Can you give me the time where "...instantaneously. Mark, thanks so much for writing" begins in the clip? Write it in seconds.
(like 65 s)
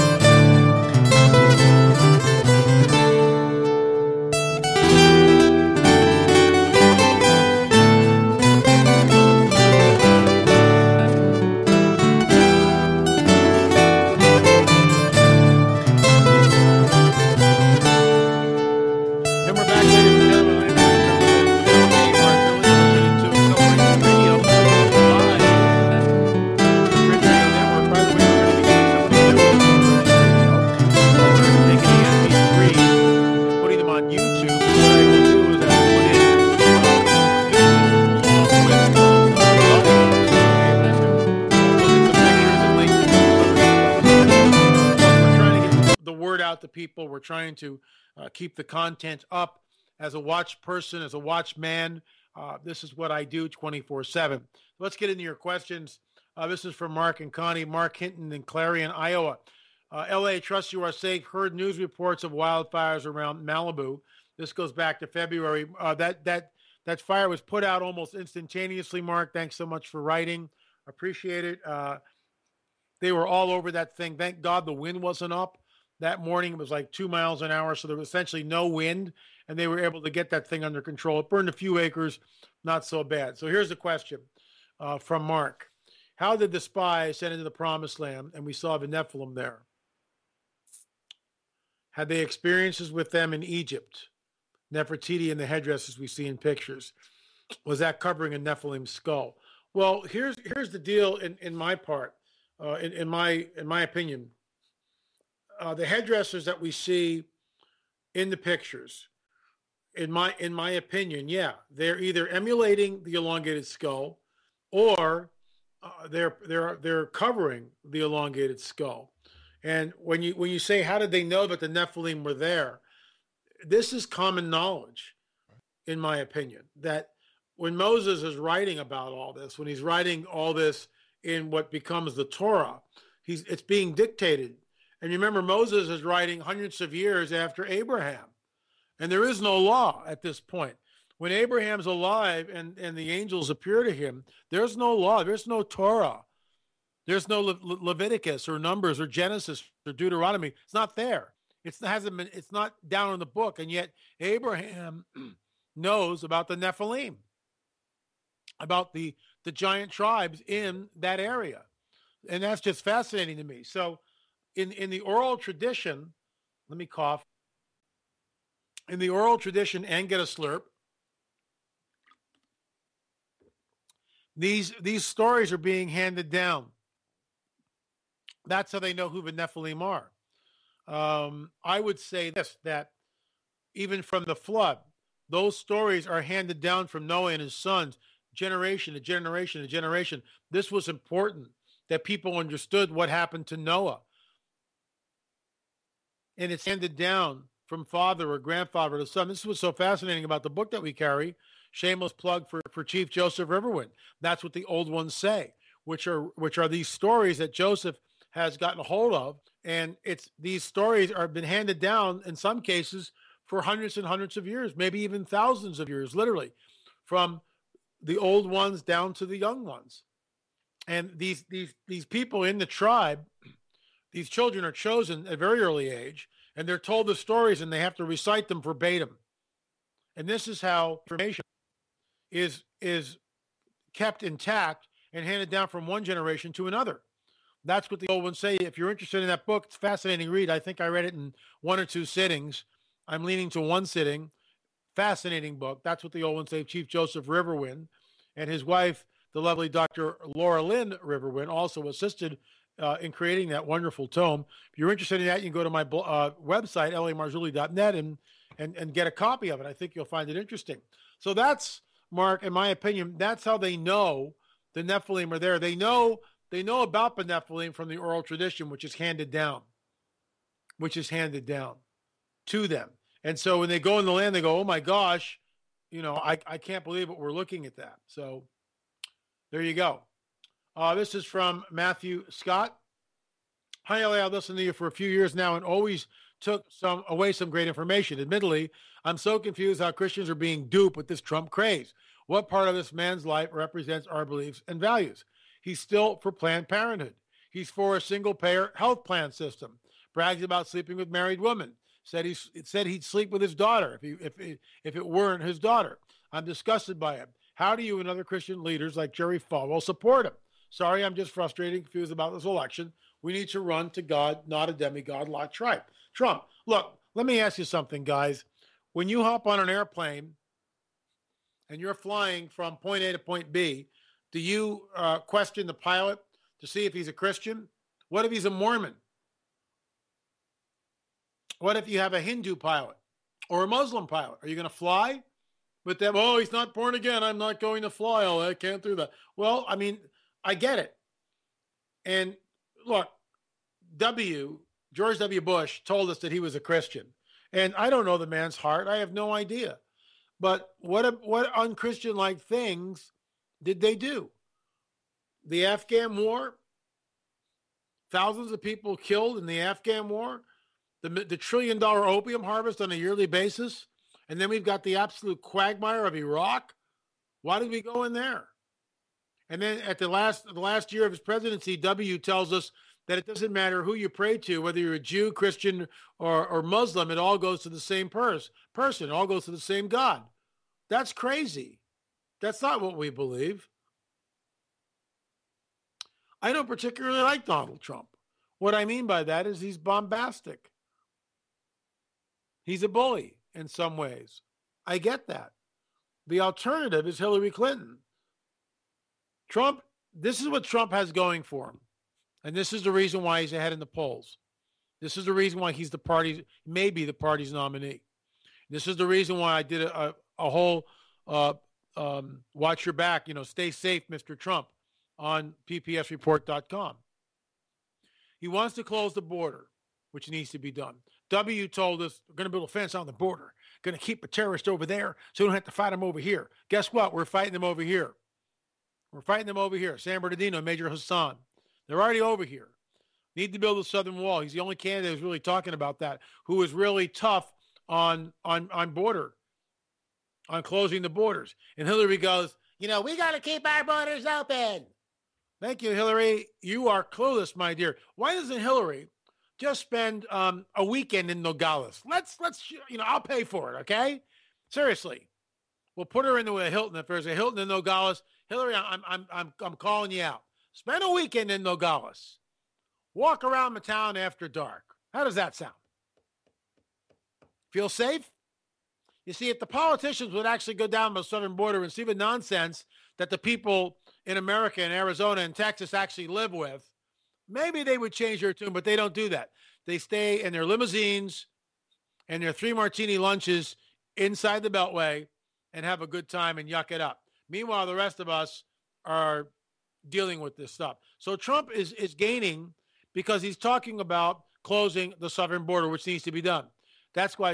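68 s.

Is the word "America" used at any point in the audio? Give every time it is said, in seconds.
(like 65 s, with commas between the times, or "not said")
474 s.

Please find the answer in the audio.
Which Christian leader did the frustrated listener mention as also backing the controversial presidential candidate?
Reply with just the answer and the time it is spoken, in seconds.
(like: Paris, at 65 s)
Jerry Falwell, at 309 s.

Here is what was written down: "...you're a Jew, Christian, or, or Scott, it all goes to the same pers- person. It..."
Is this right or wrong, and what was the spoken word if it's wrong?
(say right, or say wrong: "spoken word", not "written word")
wrong: "Muslim", not "Scott".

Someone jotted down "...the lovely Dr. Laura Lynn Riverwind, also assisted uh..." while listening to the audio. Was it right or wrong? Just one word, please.
right.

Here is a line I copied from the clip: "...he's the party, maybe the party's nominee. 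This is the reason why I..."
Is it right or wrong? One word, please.
right.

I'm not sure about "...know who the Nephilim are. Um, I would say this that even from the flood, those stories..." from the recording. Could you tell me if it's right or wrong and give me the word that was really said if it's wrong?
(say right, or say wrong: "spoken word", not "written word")
right.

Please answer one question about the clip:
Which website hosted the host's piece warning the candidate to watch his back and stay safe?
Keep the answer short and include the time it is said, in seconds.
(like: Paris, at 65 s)
ppsreport.com, at 415 s.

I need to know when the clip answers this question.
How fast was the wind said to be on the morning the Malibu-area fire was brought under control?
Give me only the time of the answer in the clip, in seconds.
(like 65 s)
76 s.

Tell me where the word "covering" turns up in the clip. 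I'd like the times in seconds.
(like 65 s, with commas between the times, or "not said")
97 s, 117 s.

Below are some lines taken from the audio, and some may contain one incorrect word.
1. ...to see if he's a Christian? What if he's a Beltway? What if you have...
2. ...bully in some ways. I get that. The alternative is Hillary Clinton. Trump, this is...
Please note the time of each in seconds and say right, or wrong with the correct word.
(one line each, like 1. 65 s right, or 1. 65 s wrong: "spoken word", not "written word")
1. 326 s wrong: "Mormon", not "Beltway"
2. 392 s right.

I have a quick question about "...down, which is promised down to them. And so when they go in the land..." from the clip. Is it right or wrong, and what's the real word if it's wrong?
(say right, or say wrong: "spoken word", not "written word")
wrong: "handed", not "promised".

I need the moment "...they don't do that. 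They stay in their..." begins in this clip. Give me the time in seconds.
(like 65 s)
478 s.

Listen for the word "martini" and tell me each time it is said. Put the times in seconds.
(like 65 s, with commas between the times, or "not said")
482 s.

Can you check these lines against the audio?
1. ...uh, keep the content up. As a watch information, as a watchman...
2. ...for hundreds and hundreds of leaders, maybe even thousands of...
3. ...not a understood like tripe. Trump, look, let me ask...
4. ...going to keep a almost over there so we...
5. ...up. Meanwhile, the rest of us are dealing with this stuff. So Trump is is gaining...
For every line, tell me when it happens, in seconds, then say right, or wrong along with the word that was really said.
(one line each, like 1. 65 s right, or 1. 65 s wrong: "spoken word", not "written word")
1. 48 s wrong: "person", not "information"
2. 213 s wrong: "years", not "leaders"
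3. 314 s wrong: "demigod", not "understood"
4. 423 s wrong: "terrorist", not "almost"
5. 486 s right.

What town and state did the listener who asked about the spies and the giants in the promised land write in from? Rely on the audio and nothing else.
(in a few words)
Clarion, Iowa.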